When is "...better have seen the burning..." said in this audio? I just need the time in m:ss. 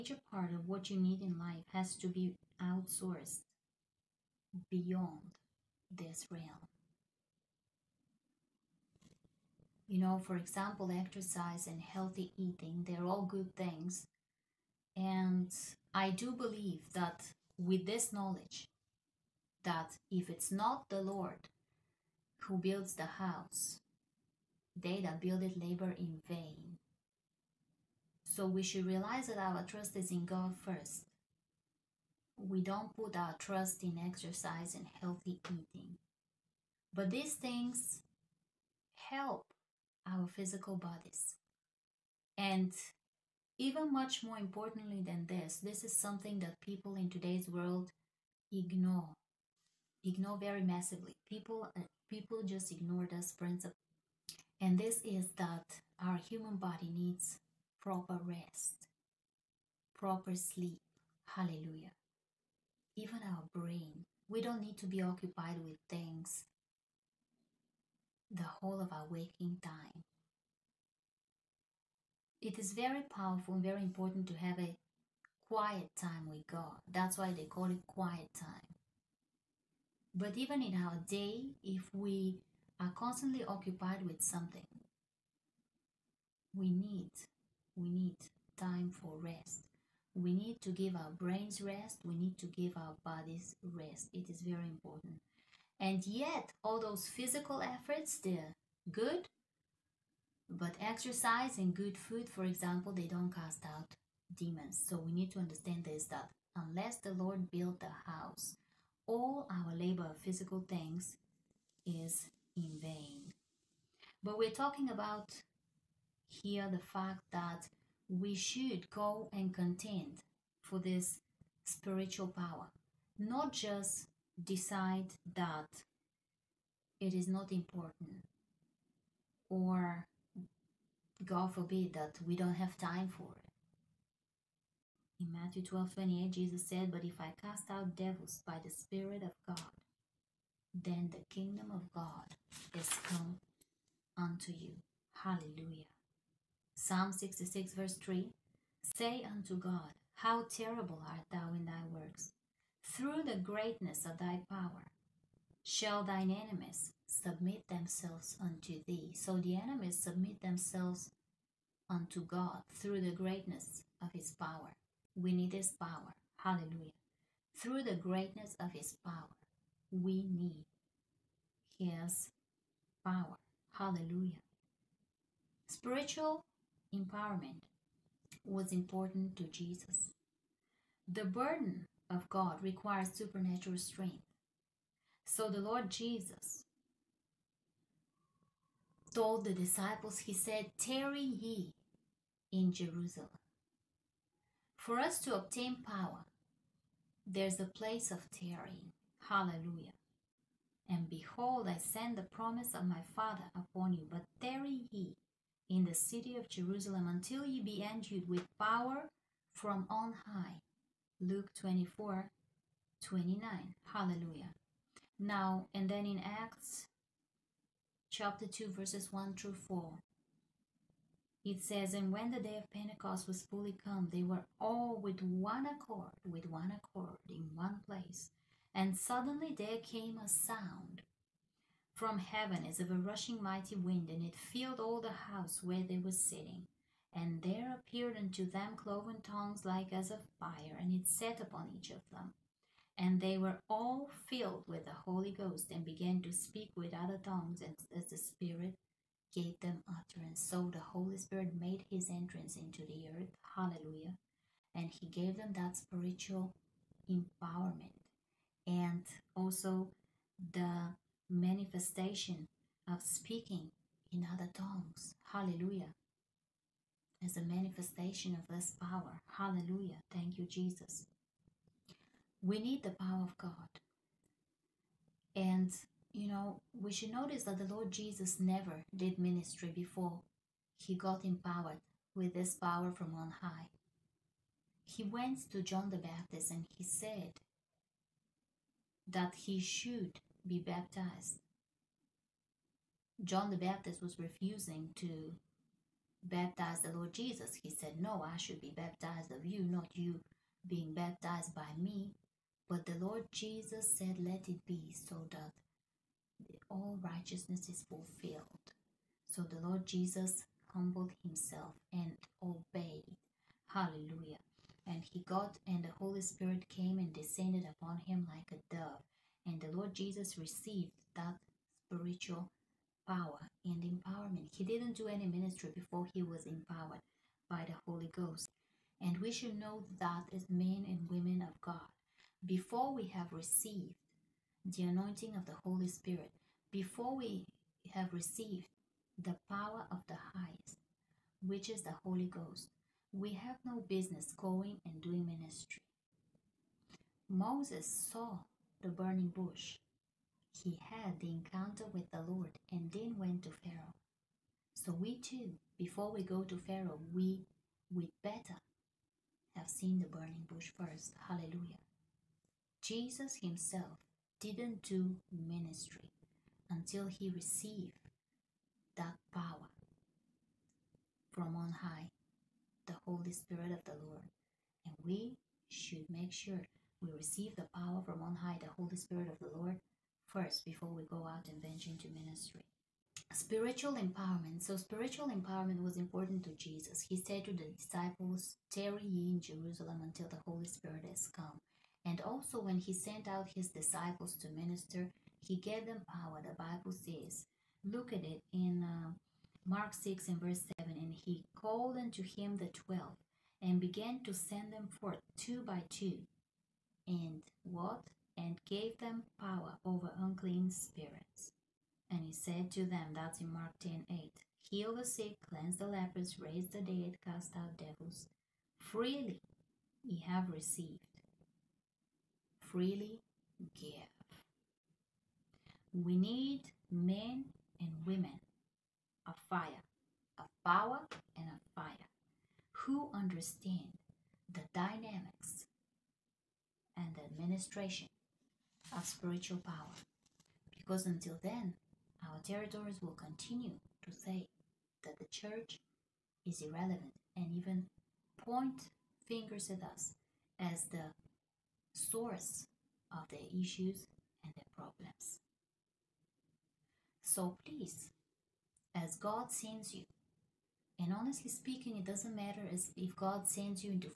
5:58.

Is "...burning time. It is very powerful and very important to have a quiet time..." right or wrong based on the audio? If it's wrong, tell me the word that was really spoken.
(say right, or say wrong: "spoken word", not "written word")
wrong: "waking", not "burning".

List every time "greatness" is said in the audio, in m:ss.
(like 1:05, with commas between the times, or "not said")
2:33, 2:43, 2:47.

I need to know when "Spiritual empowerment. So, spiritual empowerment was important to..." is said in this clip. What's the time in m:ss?
6:23.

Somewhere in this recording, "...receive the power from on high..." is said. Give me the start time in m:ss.
6:17.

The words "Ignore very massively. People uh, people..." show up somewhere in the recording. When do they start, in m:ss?
0:50.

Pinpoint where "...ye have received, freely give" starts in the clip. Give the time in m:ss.
7:00.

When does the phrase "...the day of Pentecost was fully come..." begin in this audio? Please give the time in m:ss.
3:42.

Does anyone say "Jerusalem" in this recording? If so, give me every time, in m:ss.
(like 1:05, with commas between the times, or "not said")
3:12, 3:26, 6:29.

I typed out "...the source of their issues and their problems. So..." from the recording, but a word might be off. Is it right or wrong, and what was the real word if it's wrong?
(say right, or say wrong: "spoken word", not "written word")
right.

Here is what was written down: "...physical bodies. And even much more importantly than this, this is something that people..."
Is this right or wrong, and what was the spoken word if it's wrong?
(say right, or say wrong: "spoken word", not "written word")
right.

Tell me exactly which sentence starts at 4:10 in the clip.
So the Holy Spirit made his entrance into the earth.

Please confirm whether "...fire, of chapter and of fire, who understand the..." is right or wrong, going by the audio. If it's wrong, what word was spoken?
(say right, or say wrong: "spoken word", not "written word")
wrong: "power", not "chapter".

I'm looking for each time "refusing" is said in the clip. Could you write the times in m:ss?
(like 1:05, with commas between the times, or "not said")
4:54.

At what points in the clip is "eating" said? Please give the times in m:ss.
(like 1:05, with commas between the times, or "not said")
0:12, 0:35.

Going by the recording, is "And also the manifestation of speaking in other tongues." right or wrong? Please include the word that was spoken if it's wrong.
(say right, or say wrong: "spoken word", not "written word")
right.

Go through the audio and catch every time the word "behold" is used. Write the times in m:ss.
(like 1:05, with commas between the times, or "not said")
3:21.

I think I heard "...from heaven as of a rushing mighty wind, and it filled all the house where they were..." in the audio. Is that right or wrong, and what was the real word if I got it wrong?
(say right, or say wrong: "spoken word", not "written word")
right.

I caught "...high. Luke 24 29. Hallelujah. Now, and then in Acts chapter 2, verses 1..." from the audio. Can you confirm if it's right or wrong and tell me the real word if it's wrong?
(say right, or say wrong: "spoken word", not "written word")
right.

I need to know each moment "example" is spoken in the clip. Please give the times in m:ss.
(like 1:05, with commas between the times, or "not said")
0:10, 1:42.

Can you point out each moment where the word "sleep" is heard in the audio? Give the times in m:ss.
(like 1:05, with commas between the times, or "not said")
1:00.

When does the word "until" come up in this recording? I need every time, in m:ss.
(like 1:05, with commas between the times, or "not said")
3:27, 6:06, 6:30, 7:21.